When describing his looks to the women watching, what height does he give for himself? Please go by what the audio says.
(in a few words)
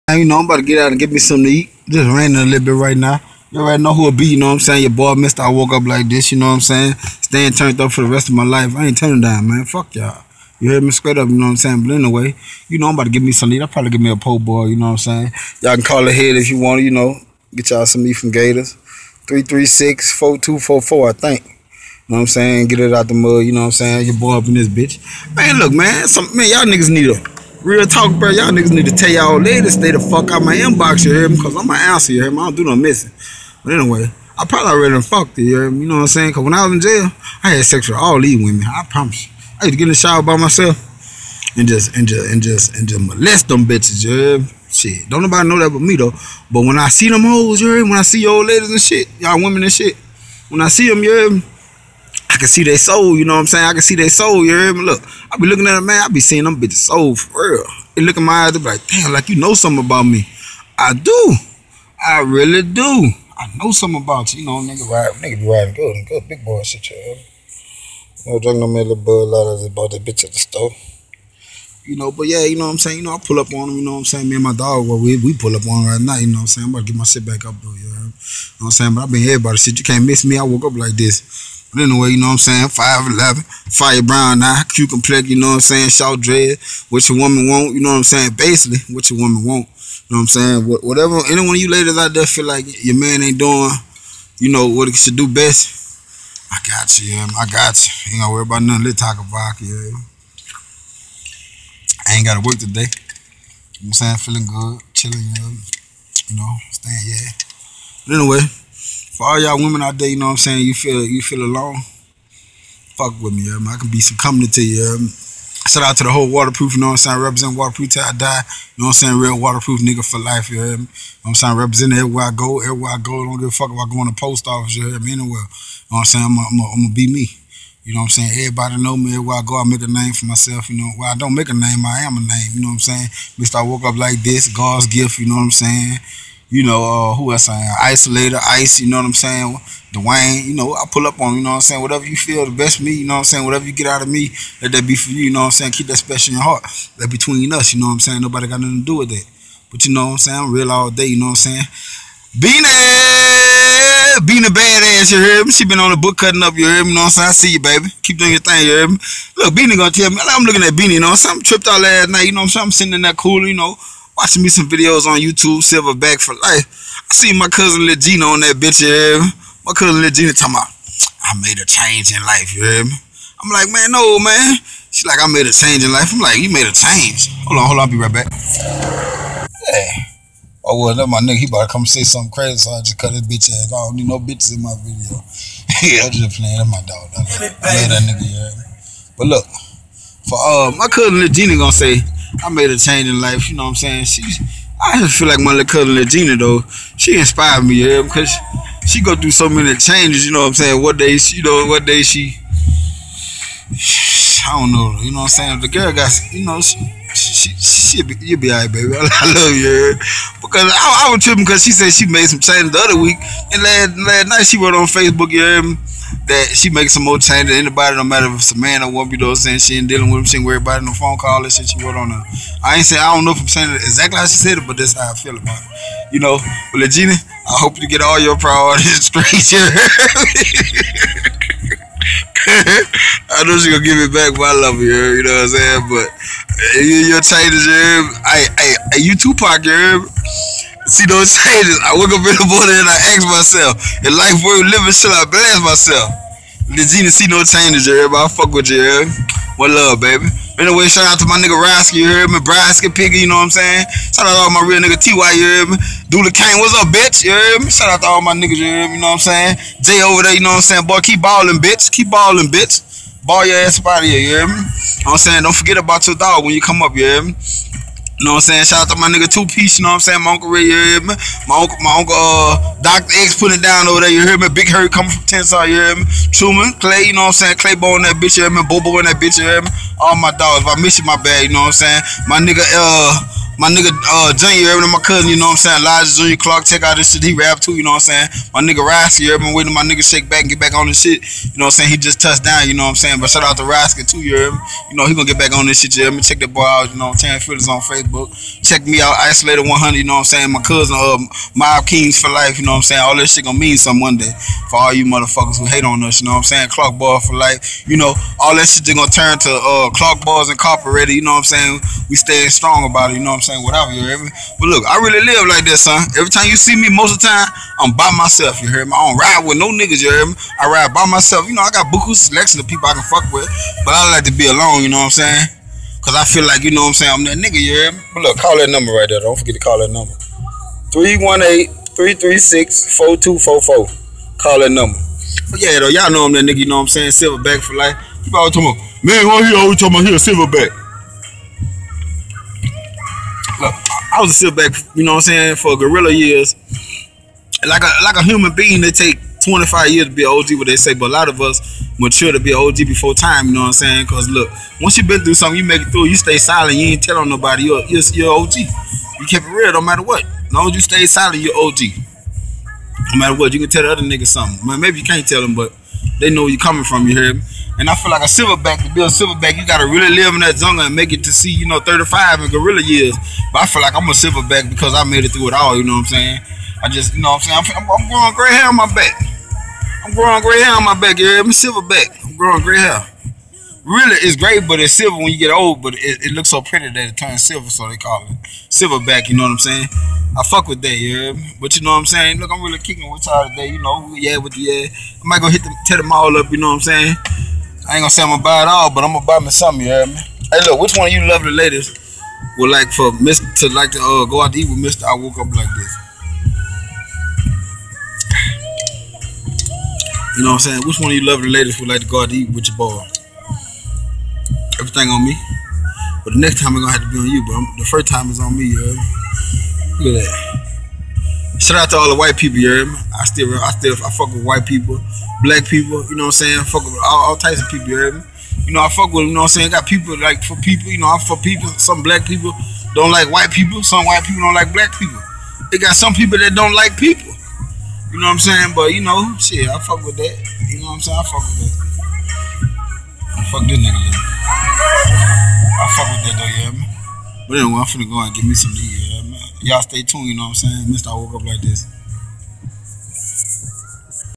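5'11.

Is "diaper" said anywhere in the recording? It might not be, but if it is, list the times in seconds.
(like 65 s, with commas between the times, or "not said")
not said.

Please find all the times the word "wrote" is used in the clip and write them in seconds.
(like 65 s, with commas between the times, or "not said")
214 s, 221 s.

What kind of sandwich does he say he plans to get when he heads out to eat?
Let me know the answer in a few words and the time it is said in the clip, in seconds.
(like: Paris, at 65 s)
po' boy, at 14 s.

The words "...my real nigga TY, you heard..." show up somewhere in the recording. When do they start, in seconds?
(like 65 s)
254 s.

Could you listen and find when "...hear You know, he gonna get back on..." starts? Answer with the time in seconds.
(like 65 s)
294 s.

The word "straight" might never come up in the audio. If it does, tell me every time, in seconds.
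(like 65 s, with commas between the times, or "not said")
10 s, 229 s.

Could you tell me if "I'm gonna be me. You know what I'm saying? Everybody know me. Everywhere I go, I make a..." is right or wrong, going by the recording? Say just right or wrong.
right.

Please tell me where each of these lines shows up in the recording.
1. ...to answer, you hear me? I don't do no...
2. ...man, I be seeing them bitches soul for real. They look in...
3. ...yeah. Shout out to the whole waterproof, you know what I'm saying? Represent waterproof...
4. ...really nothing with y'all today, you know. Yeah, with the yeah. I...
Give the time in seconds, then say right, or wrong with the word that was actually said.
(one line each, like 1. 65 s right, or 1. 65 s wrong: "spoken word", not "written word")
1. 31 s right
2. 55 s right
3. 114 s right
4. 392 s wrong: "kicking", not "nothing".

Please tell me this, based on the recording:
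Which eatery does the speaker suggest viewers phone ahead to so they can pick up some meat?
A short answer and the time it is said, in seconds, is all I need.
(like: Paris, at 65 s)
Gators, at 18 s.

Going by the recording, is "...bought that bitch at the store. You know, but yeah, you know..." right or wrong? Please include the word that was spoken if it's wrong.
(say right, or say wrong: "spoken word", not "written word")
right.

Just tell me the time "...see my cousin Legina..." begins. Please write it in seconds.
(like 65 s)
167 s.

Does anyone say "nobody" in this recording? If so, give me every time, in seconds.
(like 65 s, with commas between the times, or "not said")
45 s, 148 s, 357 s.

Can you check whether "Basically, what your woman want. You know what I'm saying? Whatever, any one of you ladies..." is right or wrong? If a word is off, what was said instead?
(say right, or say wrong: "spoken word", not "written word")
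right.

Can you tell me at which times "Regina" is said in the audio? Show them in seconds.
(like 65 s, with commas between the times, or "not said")
195 s, 226 s.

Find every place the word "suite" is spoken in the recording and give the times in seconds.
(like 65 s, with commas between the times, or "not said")
not said.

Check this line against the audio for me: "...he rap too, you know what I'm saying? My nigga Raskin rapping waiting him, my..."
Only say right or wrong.
right.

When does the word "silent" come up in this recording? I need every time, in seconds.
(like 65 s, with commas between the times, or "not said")
356 s, 361 s.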